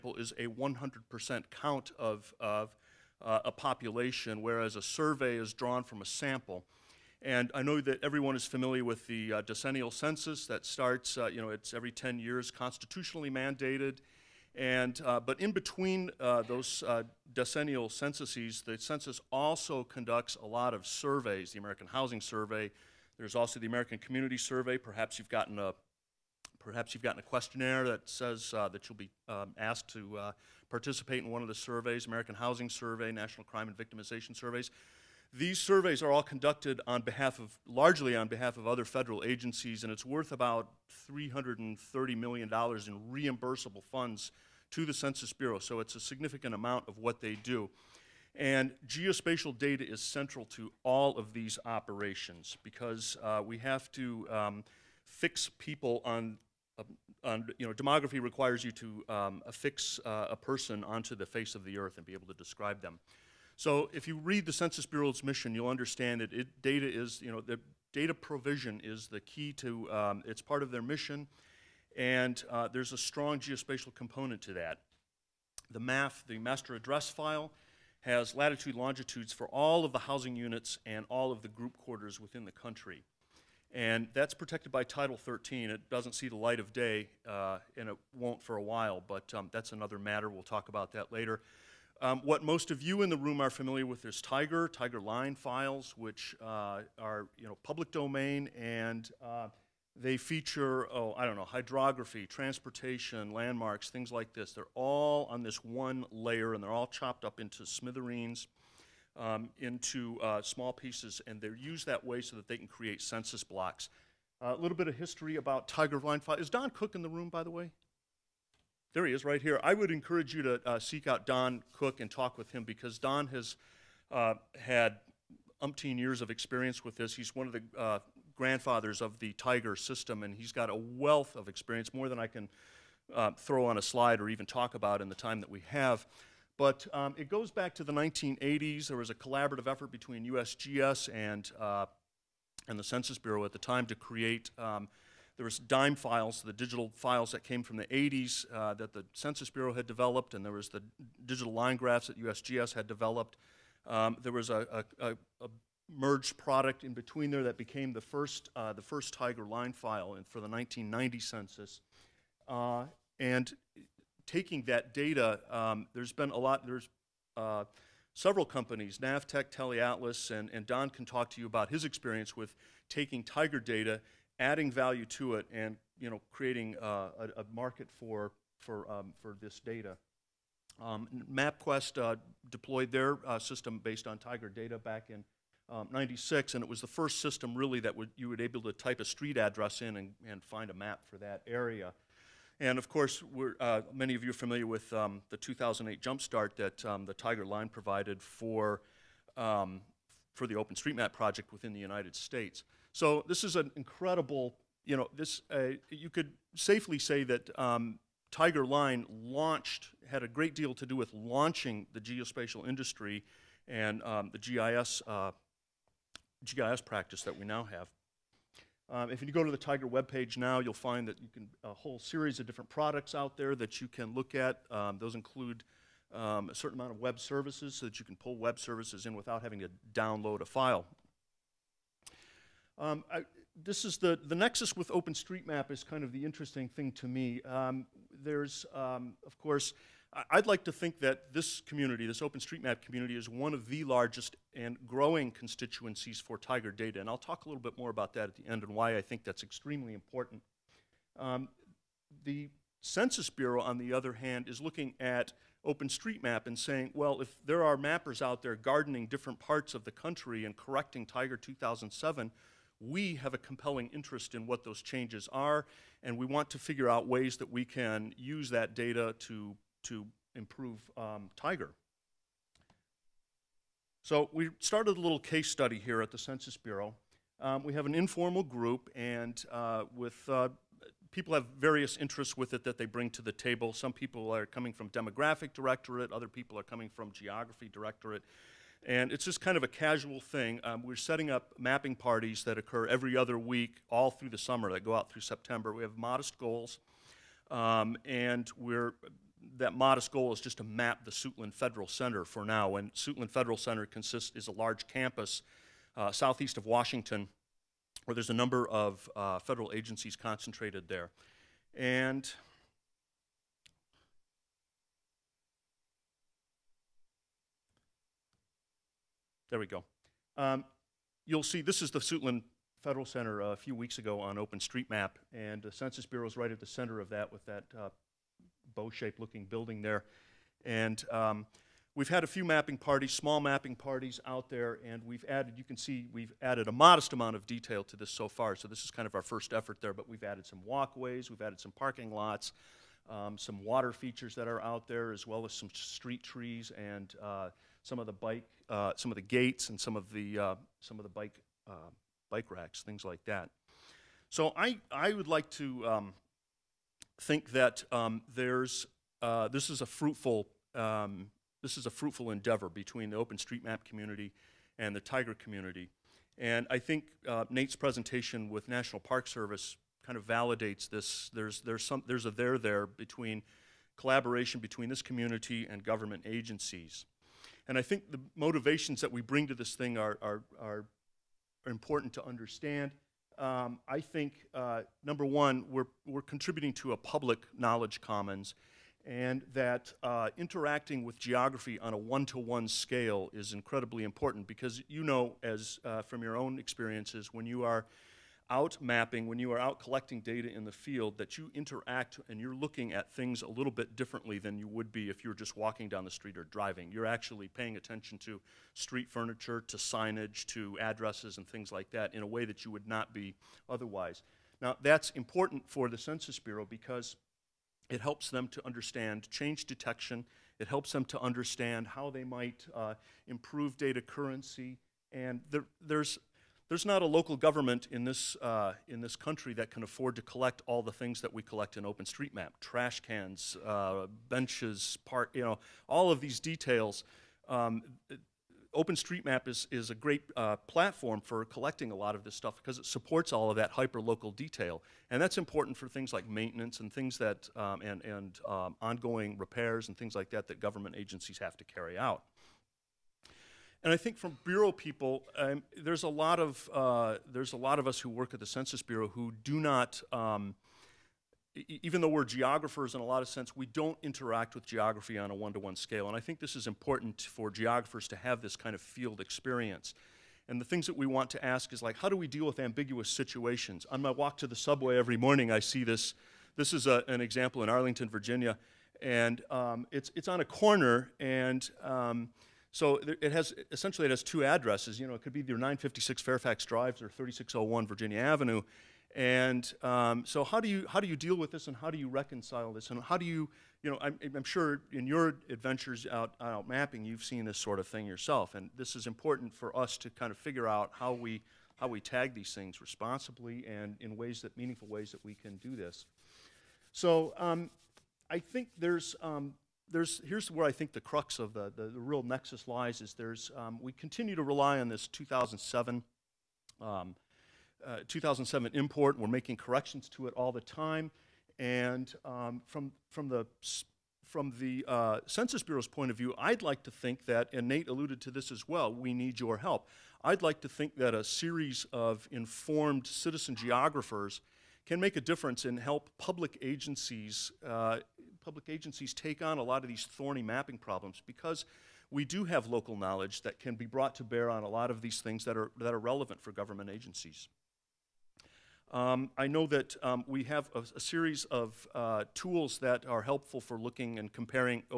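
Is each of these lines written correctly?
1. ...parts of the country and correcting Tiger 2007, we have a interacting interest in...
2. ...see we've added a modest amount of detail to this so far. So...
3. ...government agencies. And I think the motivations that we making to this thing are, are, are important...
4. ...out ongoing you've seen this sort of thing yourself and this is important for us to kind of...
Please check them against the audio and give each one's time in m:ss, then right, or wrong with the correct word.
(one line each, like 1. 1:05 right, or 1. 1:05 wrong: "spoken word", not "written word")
1. 4:19 wrong: "compelling", not "interacting"
2. 5:35 right
3. 6:15 wrong: "bring", not "making"
4. 8:16 wrong: "mapping", not "ongoing".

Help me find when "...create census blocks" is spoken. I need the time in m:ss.
1:52.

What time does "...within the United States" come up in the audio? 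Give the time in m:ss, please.
3:21.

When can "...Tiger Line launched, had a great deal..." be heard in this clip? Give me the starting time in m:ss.
3:28.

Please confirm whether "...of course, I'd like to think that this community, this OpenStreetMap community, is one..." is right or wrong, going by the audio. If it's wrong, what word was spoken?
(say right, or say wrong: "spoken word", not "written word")
right.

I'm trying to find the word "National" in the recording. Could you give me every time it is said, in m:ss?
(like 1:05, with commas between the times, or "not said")
0:33, 6:08.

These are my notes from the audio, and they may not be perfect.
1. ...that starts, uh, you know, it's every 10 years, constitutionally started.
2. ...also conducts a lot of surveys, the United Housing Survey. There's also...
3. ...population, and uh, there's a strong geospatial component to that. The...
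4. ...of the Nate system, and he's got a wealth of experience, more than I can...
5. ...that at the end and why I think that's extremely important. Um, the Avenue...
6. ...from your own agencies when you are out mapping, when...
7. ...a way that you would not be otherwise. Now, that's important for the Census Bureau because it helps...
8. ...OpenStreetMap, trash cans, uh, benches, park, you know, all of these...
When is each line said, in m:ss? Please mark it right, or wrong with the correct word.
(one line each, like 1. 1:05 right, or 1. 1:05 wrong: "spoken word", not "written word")
1. 0:10 wrong: "mandated", not "started"
2. 0:19 wrong: "American", not "United"
3. 1:10 wrong: "mission", not "population"
4. 2:09 wrong: "Tiger", not "Nate"
5. 4:08 wrong: "Census", not "Avenue"
6. 6:36 wrong: "experiences", not "agencies"
7. 6:52 right
8. 7:11 right.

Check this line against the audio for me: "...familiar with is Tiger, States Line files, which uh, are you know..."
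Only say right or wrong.
wrong.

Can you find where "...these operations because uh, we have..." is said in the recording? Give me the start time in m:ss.
0:51.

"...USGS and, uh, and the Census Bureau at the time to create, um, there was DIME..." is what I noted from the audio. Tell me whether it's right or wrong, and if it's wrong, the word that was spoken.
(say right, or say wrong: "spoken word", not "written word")
right.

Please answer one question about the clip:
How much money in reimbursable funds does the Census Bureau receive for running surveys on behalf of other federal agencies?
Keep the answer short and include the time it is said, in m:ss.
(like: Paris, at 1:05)
$330 million, at 0:41.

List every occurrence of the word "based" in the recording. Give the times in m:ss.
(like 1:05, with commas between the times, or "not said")
3:03.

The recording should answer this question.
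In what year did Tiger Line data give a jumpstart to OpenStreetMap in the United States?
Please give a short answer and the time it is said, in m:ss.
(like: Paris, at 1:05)
2008, at 3:15.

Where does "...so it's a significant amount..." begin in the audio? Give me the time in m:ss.
0:45.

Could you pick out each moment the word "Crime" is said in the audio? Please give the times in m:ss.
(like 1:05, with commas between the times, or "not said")
0:33.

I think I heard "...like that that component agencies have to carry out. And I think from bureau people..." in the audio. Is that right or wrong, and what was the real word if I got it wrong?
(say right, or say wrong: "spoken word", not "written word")
wrong: "government", not "component".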